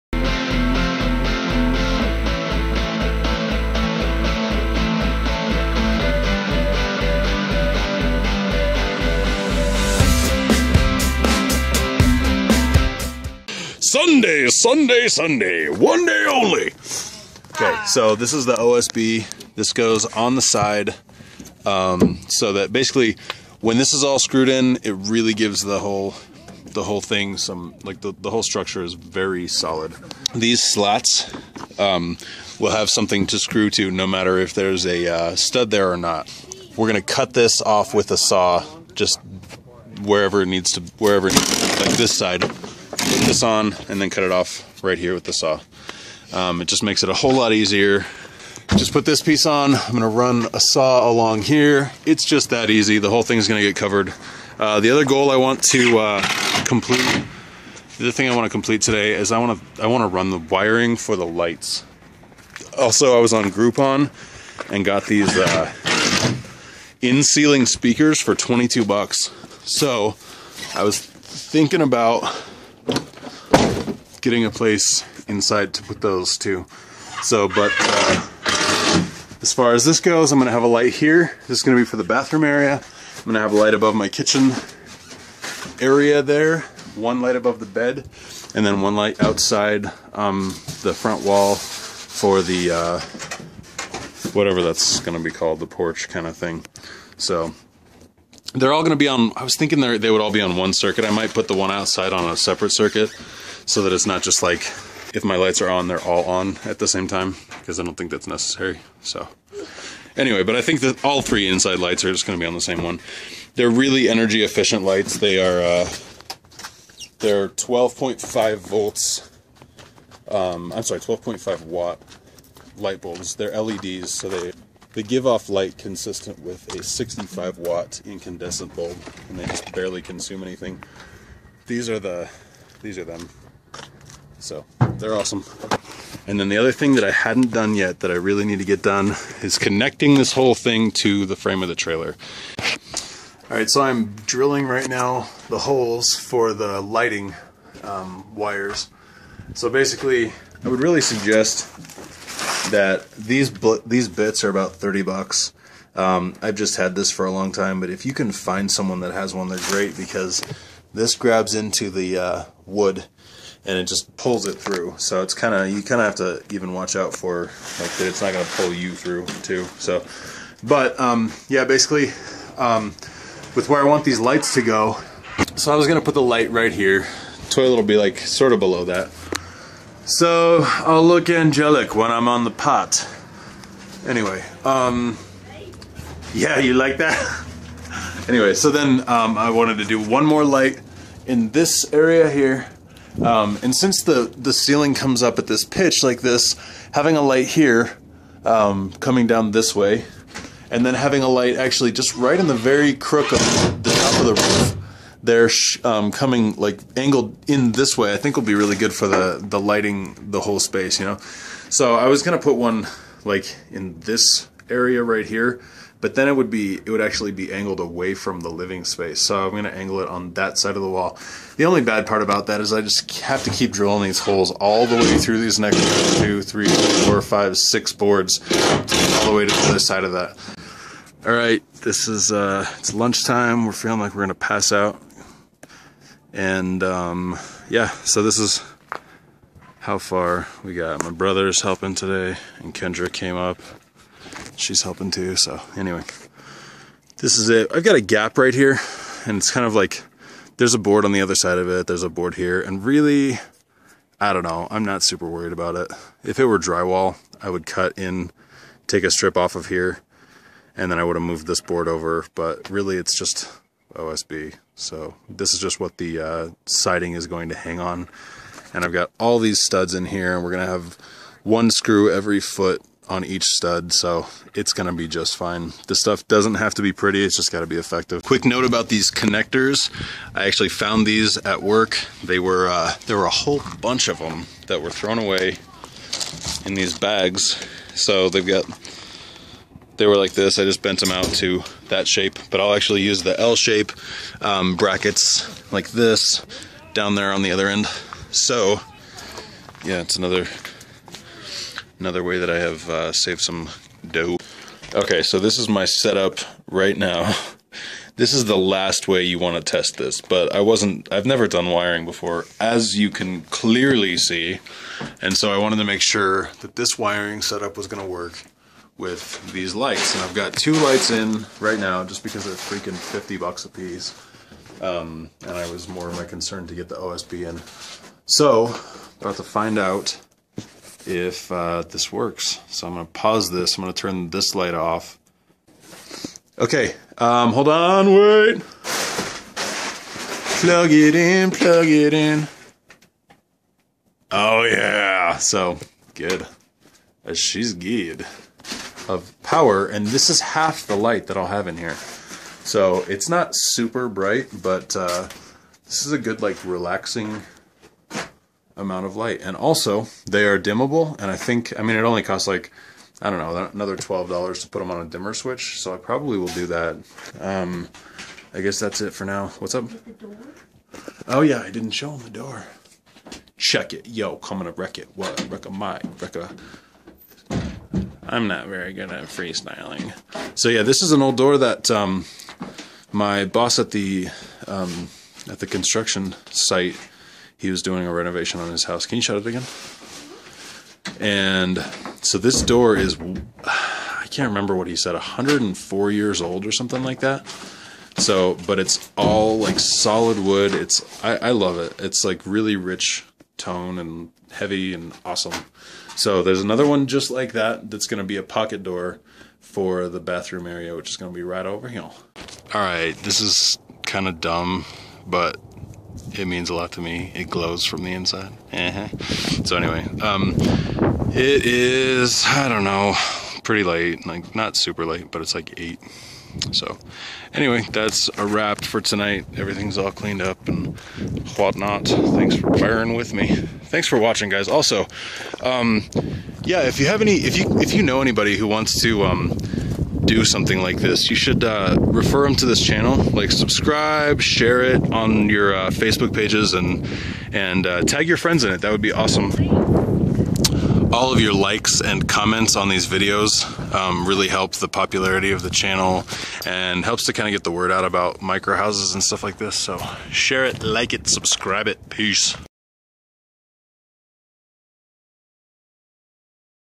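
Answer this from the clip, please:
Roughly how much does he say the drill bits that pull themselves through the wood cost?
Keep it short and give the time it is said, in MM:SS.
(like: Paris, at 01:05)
$30, at 02:34.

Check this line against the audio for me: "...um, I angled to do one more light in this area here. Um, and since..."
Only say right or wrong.
wrong.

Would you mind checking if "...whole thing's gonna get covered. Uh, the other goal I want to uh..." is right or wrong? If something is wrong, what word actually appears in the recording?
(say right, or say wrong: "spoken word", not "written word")
right.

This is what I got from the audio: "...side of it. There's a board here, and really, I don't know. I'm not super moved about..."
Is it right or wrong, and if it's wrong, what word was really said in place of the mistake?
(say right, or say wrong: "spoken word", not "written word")
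wrong: "worried", not "moved".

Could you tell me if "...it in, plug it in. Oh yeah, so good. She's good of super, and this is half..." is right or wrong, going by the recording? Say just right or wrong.
wrong.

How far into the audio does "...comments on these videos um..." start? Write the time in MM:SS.
07:32.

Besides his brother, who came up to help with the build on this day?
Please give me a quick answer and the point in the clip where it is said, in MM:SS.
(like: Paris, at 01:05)
Kendra, at 04:02.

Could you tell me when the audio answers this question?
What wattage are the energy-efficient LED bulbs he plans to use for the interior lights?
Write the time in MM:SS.
02:00.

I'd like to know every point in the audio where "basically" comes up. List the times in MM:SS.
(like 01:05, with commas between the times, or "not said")
00:22, 02:29, 02:51.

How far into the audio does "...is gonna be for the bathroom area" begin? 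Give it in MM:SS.
01:21.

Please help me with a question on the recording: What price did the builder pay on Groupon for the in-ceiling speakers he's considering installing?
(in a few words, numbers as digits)
$22.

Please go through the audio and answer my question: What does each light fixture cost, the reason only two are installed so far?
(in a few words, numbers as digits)
$50.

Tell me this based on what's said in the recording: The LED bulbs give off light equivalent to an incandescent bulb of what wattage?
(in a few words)
65 watts.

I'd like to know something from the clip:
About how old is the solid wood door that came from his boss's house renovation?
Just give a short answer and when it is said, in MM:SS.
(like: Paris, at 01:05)
104 years, at 06:35.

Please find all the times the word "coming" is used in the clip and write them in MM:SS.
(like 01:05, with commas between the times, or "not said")
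03:18, 03:26, 06:14.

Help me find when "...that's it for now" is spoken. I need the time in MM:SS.
06:08.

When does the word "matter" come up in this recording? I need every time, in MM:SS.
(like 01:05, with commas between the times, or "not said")
00:34.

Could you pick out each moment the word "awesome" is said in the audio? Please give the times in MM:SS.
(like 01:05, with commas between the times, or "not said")
02:15, 06:45, 07:29.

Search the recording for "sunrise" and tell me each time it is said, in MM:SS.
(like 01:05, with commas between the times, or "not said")
not said.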